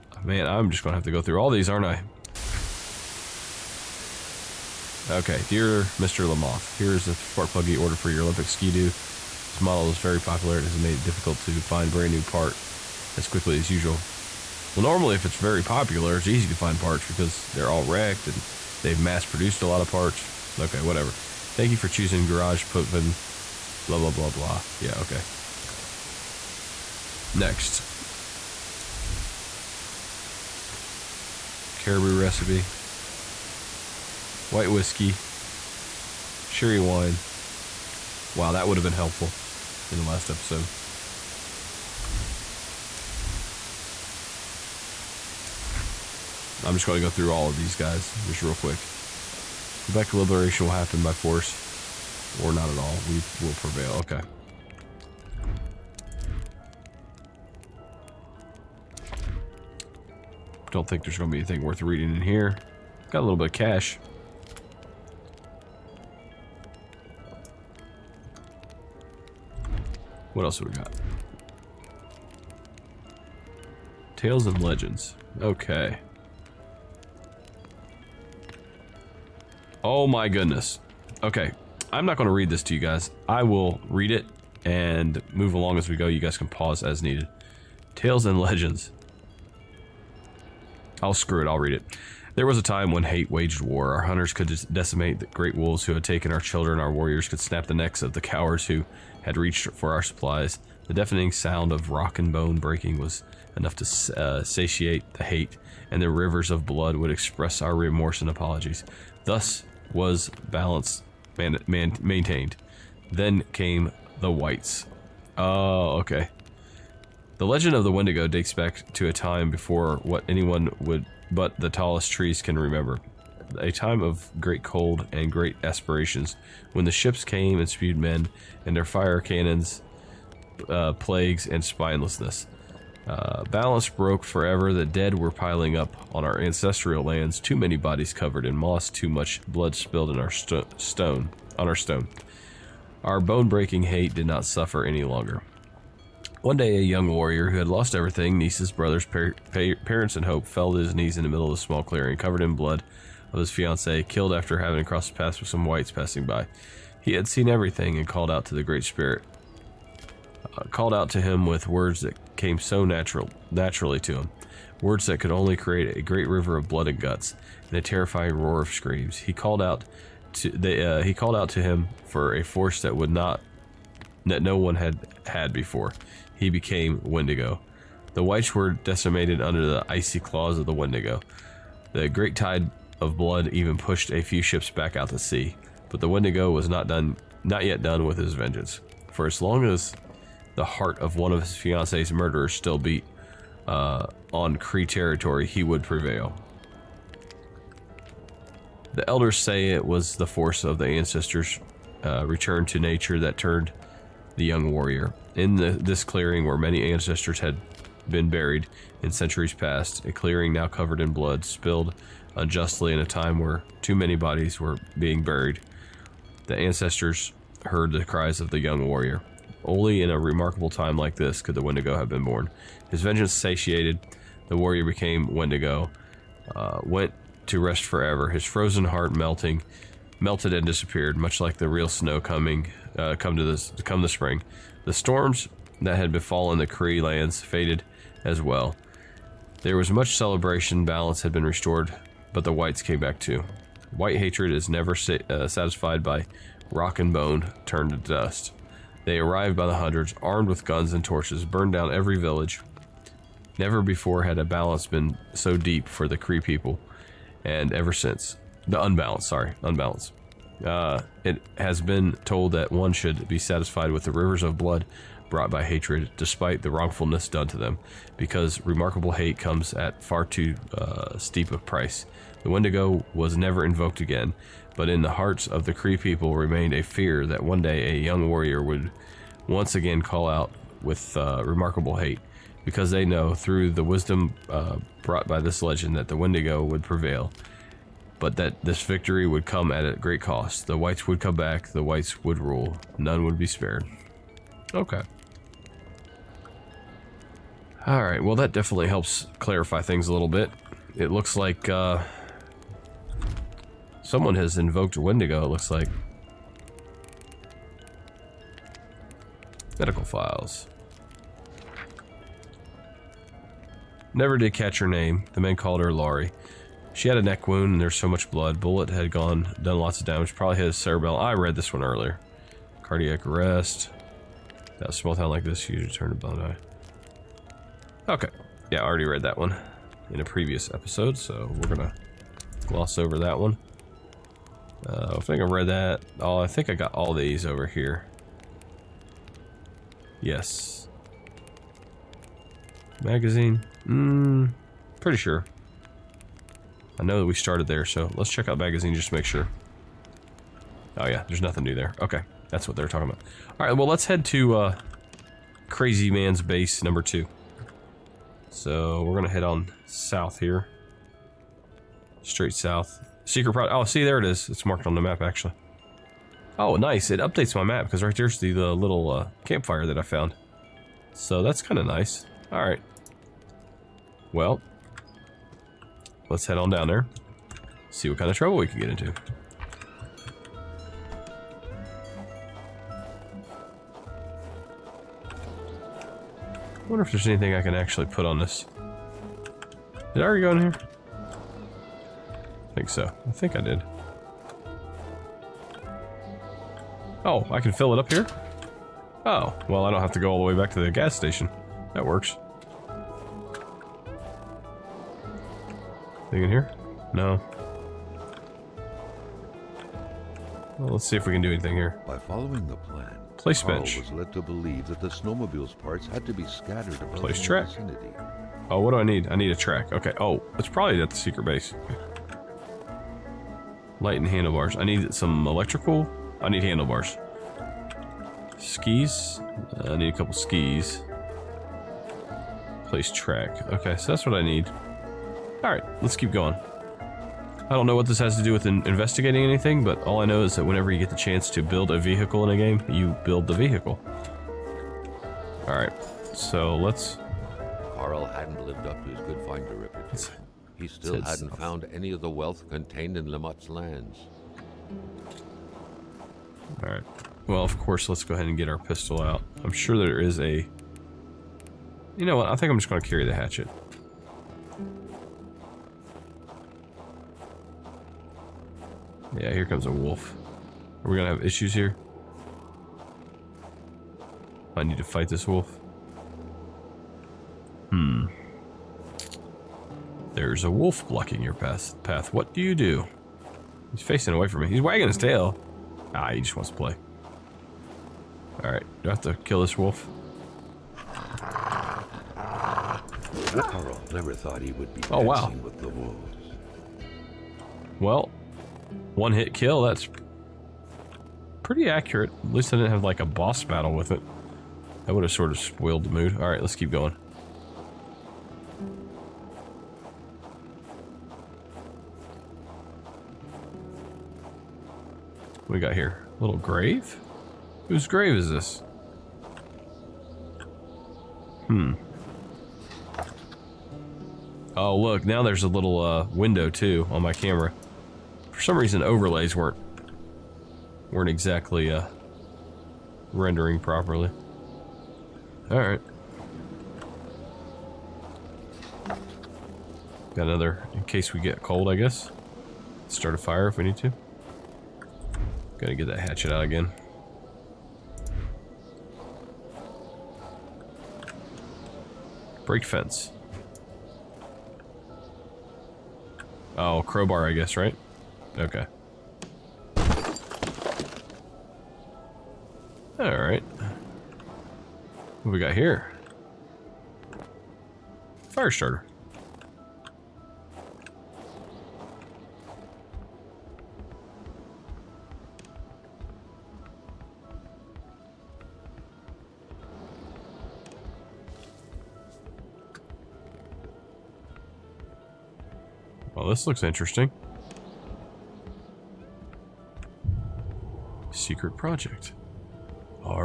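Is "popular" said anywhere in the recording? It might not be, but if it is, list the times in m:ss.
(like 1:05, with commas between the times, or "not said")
0:10, 0:15.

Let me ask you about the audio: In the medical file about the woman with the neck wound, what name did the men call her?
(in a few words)
Laurie.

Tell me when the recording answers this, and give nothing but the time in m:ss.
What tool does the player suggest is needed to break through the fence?
9:17.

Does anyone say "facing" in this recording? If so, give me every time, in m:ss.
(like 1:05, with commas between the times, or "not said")
8:04.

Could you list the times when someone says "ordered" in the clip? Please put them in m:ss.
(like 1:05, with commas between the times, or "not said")
0:07.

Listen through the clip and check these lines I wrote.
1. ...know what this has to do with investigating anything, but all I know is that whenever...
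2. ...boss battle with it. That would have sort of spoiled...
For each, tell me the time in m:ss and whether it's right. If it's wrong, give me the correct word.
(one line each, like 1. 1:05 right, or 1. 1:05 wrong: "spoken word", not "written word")
1. 7:17 right
2. 8:23 right.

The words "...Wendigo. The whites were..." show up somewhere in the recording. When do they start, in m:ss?
2:57.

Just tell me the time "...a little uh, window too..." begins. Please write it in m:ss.
8:45.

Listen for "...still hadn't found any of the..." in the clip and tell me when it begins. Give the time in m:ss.
7:30.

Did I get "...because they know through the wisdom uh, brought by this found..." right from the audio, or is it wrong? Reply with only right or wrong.
wrong.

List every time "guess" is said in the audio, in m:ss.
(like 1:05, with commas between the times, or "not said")
9:01, 9:17.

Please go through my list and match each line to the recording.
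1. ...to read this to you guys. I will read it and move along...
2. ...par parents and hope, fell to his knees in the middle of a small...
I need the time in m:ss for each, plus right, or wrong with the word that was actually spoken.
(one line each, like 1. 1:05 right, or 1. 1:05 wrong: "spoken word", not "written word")
1. 1:22 right
2. 2:29 right.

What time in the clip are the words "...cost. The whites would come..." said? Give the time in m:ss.
4:50.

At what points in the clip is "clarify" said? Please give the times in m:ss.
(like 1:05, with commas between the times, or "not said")
4:59.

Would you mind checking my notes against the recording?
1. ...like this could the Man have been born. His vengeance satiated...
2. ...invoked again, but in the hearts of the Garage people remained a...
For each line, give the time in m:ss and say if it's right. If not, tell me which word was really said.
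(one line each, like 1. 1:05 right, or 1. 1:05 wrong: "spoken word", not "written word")
1. 3:40 wrong: "Wendigo", not "Man"
2. 4:33 wrong: "Cree", not "Garage".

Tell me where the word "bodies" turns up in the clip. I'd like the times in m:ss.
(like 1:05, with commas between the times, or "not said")
2:17, 3:34.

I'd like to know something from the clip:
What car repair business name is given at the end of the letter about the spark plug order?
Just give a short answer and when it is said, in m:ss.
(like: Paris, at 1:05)
Garage Potvin, at 0:22.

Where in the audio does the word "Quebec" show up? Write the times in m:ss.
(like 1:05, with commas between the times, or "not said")
0:49.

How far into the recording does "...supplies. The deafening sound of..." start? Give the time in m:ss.
1:40.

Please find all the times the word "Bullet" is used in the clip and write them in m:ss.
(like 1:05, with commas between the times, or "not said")
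5:18.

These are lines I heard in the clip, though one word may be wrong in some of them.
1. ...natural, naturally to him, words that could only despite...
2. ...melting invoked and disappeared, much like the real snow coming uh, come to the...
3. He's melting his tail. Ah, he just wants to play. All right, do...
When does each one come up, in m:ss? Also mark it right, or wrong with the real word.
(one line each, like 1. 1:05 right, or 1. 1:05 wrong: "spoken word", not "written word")
1. 2:42 wrong: "create", not "despite"
2. 3:49 wrong: "melted", not "invoked"
3. 8:04 wrong: "wagging", not "melting".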